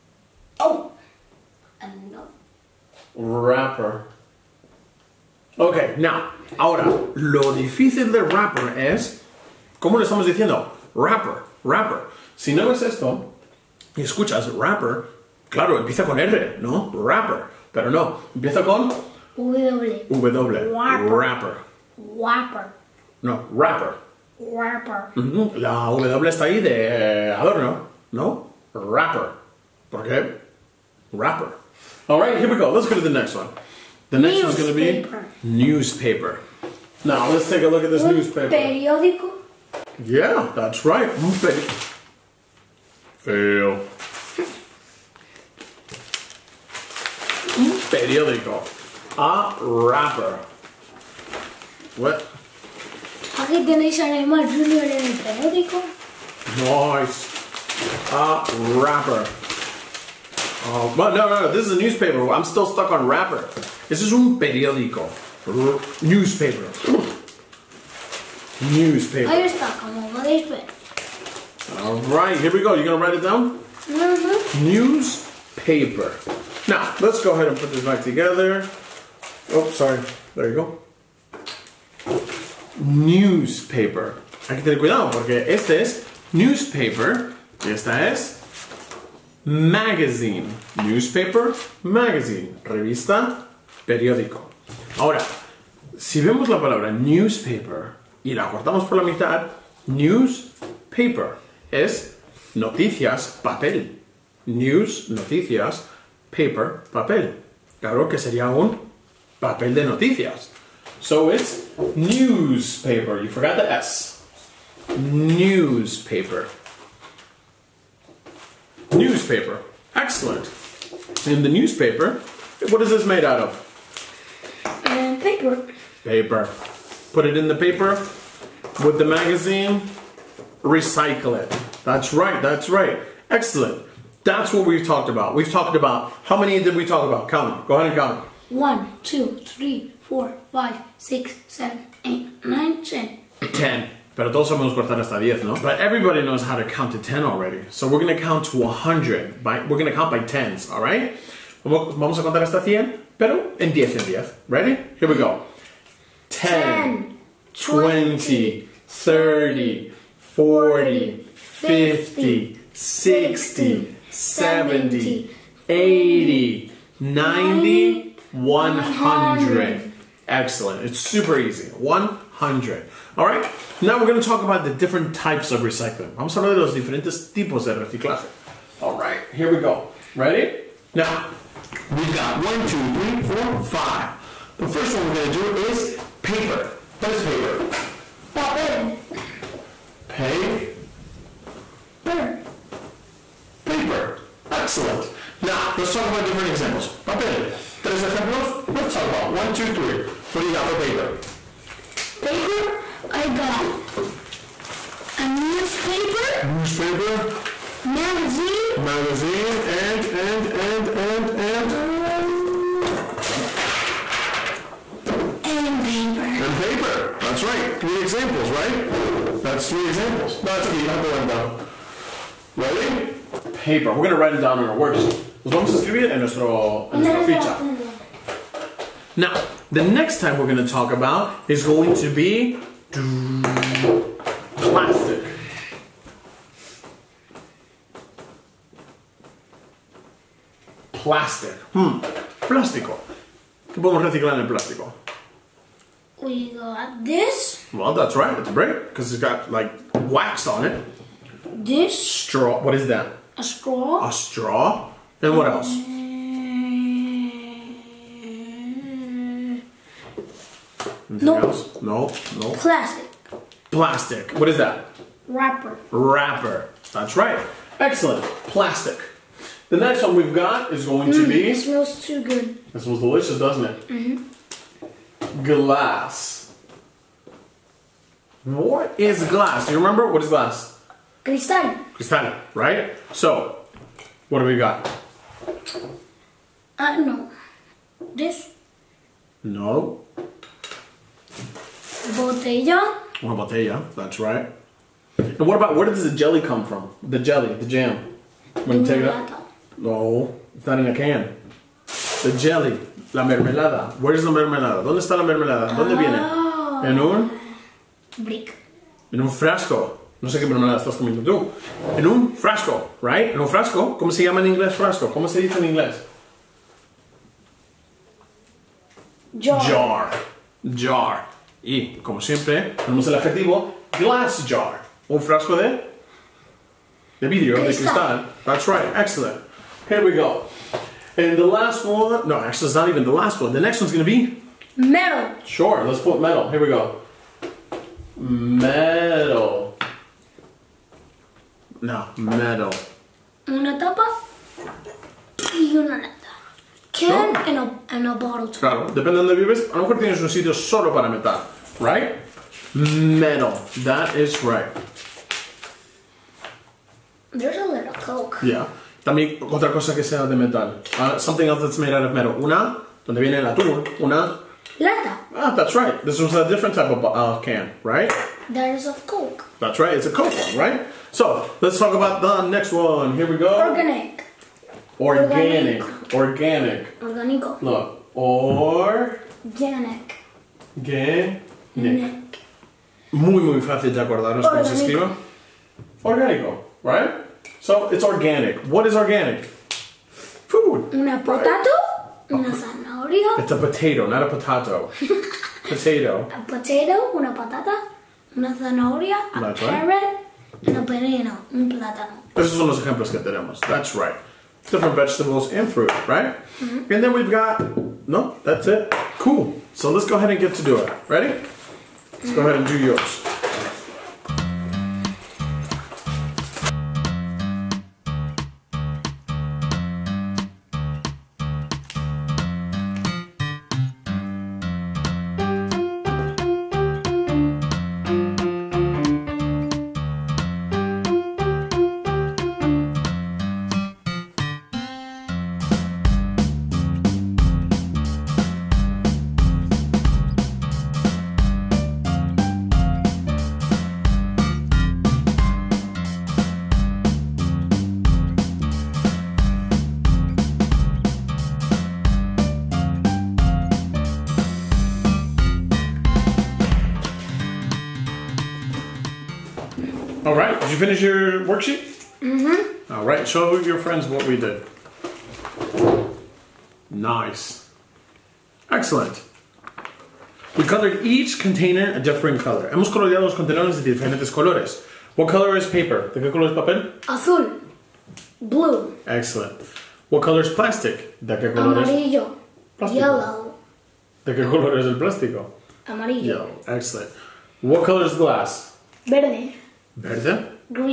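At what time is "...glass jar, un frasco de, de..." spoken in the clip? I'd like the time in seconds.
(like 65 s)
323 s.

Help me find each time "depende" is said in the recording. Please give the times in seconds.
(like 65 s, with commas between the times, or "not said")
348 s.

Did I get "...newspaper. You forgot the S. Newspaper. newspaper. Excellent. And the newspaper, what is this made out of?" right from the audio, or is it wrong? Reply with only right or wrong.
right.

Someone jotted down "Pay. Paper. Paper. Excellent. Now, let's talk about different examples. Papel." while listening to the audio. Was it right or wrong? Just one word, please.
right.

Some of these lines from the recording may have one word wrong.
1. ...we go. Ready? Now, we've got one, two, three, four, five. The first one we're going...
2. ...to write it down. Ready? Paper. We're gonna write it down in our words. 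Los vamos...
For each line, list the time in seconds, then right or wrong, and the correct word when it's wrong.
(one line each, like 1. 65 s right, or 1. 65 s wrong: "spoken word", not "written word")
1. 179 s right
2. 221 s right.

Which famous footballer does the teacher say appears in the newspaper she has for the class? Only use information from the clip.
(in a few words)
Neymar Junior.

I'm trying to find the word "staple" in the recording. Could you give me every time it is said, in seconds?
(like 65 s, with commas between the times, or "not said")
not said.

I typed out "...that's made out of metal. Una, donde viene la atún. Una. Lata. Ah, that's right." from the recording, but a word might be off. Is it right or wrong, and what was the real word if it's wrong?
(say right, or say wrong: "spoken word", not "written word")
right.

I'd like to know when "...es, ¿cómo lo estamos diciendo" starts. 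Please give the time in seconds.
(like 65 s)
8 s.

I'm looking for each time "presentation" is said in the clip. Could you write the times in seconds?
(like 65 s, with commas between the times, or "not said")
not said.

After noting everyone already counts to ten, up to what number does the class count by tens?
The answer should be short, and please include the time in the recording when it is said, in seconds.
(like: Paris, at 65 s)
100, at 151 s.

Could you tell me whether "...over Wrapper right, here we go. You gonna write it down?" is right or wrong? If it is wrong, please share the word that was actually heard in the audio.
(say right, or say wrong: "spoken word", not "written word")
wrong: "All", not "Wrapper".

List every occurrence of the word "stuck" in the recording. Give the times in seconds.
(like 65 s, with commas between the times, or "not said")
62 s, 69 s.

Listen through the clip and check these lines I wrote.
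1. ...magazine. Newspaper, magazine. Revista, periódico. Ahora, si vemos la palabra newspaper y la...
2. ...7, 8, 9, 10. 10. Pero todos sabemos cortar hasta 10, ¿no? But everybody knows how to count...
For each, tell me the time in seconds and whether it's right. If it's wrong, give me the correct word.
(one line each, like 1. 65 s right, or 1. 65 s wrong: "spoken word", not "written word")
1. 89 s right
2. 141 s right.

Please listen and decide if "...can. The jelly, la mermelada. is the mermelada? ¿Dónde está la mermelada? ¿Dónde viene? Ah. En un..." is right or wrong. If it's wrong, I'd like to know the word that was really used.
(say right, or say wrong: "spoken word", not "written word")
right.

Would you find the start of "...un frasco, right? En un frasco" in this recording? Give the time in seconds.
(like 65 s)
312 s.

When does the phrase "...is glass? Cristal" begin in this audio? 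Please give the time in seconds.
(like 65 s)
280 s.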